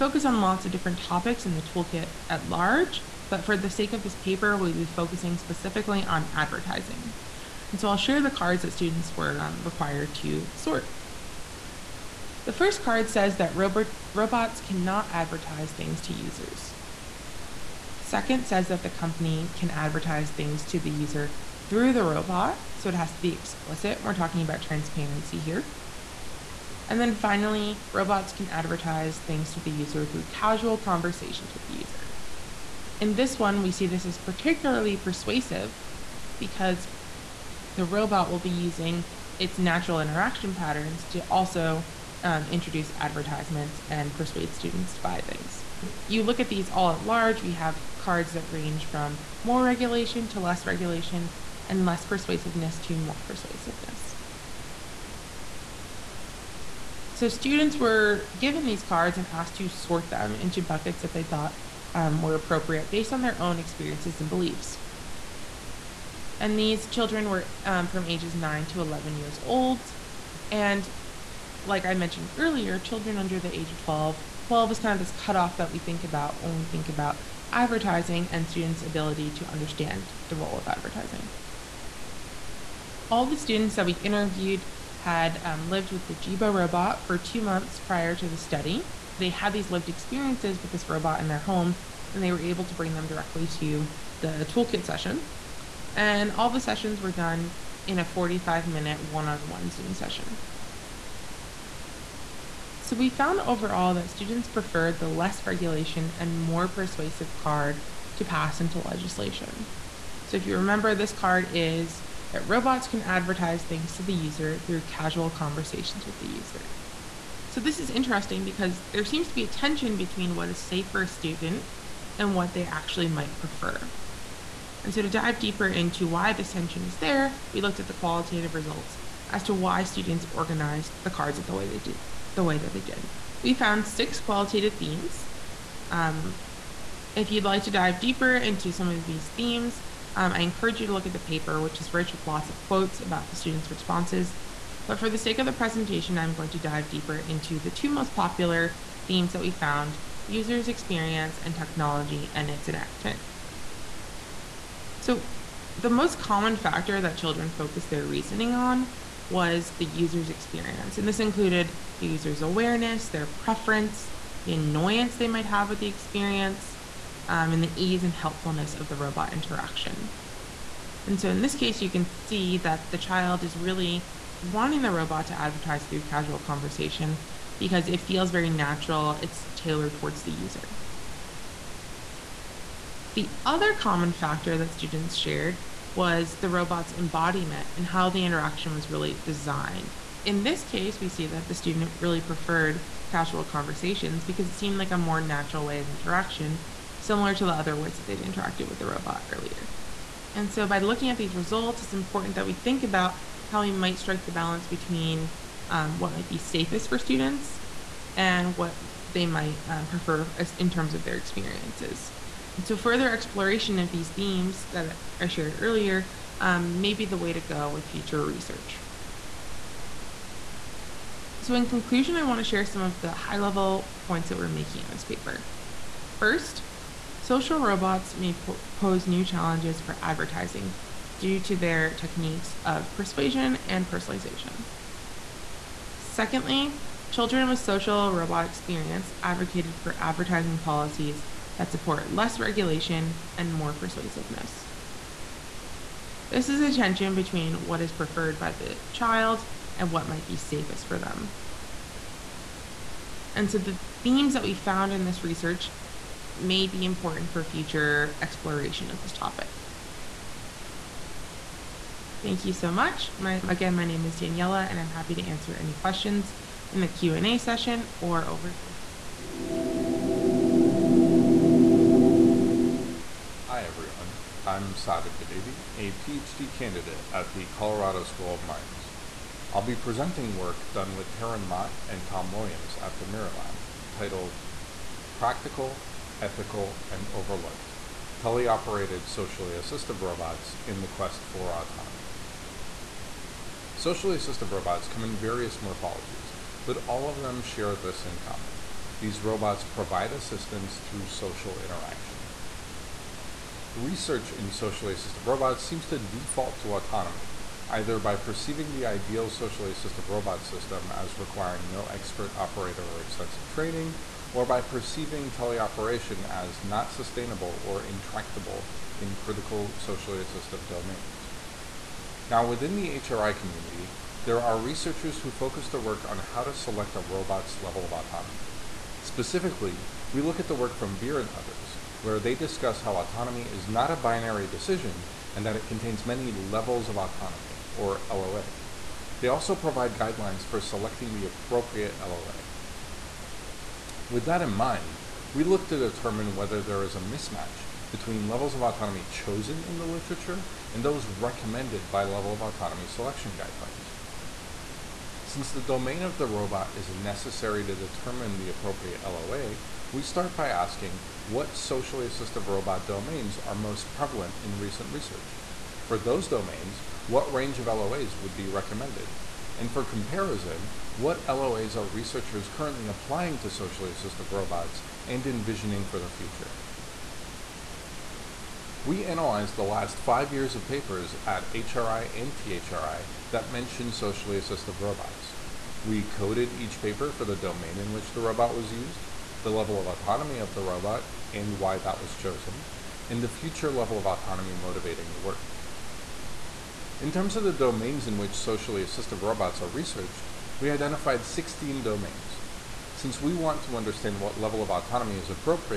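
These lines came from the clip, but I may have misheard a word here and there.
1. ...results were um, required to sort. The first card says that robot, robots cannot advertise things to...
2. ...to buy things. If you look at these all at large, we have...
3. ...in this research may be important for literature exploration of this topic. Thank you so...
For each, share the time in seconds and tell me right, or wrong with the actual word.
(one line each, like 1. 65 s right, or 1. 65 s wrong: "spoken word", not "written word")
1. 8 s wrong: "students", not "results"
2. 44 s right
3. 254 s wrong: "future", not "literature".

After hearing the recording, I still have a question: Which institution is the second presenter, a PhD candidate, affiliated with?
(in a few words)
Colorado School of Mines.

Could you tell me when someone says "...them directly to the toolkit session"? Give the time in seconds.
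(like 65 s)
92 s.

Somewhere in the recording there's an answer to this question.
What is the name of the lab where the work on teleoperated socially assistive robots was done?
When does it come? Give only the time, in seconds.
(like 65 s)
283 s.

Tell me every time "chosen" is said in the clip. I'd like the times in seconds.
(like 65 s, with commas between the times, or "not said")
349 s, 392 s.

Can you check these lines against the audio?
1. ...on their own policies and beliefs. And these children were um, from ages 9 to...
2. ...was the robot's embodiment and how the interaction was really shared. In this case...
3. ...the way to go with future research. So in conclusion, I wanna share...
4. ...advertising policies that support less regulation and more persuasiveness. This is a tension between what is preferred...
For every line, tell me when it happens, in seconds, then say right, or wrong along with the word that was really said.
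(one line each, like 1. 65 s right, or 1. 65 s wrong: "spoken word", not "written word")
1. 63 s wrong: "experiences", not "policies"
2. 185 s wrong: "designed", not "shared"
3. 217 s right
4. 239 s right.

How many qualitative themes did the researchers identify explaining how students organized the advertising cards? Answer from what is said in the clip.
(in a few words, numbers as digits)
6.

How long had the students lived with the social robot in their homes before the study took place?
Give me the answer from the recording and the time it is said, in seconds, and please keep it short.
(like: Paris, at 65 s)
two months, at 87 s.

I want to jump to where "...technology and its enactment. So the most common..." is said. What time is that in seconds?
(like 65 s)
151 s.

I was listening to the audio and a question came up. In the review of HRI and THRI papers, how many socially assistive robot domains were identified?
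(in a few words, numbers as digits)
16.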